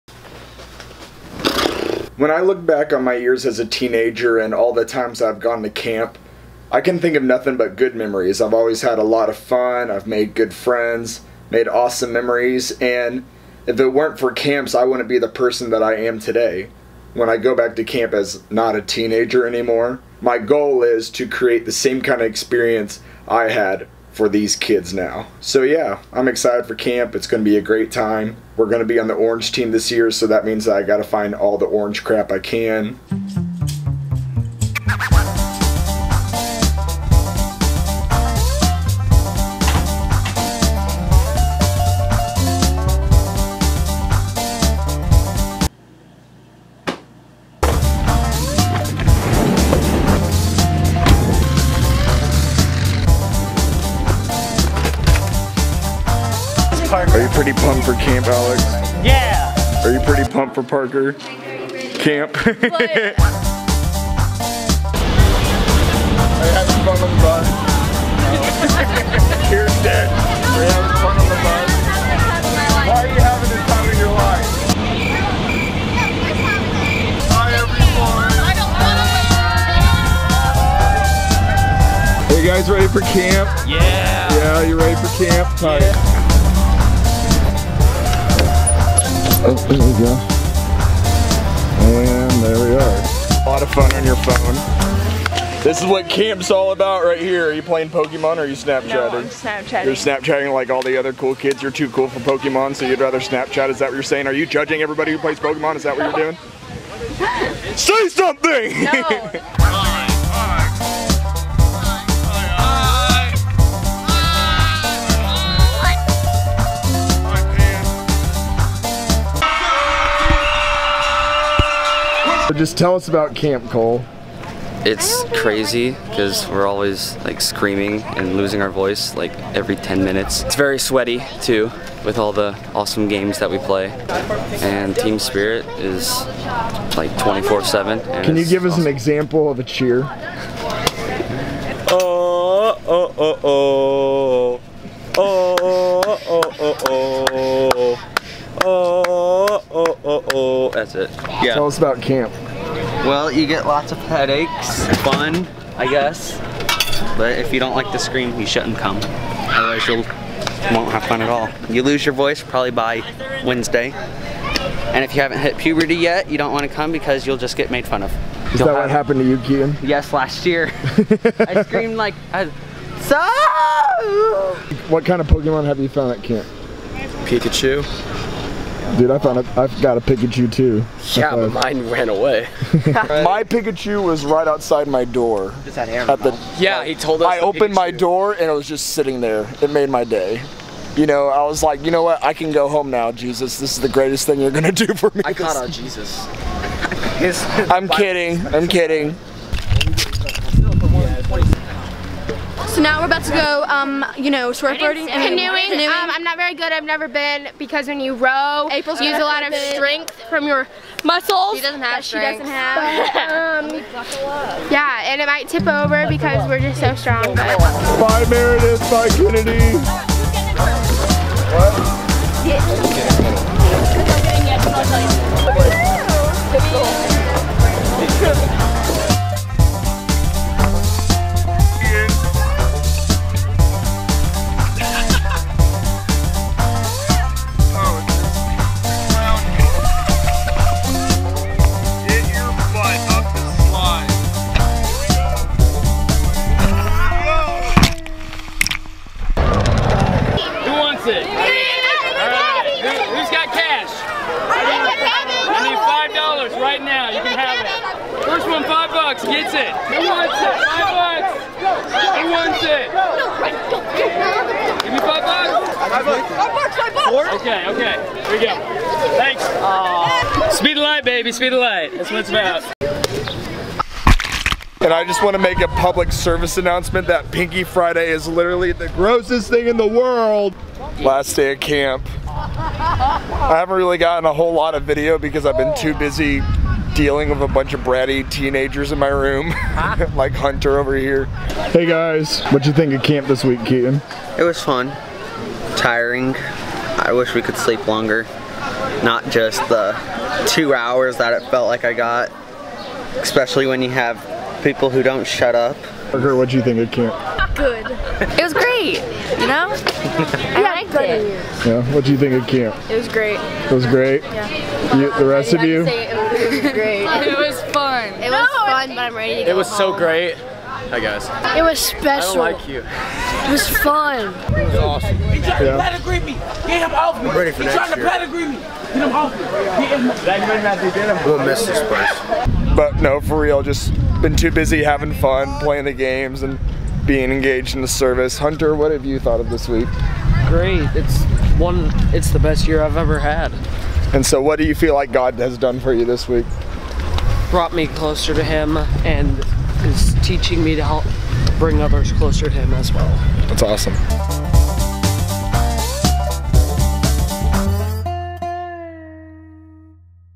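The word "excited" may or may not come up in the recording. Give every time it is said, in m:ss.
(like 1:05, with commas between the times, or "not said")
0:26.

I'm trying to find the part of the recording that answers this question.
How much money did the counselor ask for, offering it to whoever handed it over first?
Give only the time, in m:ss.
4:15.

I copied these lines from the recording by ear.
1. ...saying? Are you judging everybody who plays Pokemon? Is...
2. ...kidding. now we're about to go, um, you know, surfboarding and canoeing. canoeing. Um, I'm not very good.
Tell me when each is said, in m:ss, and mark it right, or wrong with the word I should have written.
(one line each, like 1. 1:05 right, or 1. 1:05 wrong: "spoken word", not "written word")
1. 1:44 right
2. 3:18 right.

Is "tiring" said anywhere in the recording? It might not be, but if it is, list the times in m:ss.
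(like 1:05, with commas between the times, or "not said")
4:55.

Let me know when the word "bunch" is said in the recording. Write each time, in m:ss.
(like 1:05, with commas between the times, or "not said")
4:47.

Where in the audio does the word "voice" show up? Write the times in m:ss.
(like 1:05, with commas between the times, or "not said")
2:08, 2:42.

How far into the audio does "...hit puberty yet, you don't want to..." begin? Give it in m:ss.
2:45.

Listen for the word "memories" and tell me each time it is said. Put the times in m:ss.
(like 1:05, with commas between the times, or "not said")
0:07, 0:12.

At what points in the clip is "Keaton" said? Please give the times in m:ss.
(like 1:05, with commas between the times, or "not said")
2:49, 4:53.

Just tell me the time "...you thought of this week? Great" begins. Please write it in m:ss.
5:39.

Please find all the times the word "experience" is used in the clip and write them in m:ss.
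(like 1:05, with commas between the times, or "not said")
0:22.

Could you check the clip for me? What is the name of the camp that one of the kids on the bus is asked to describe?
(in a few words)
Camp Cole.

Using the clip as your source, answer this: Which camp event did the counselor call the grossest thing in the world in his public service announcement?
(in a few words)
Pinky Friday.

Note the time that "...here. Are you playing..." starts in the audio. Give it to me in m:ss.
1:37.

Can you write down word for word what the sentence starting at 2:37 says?
But if you don't like to scream, you shouldn't come.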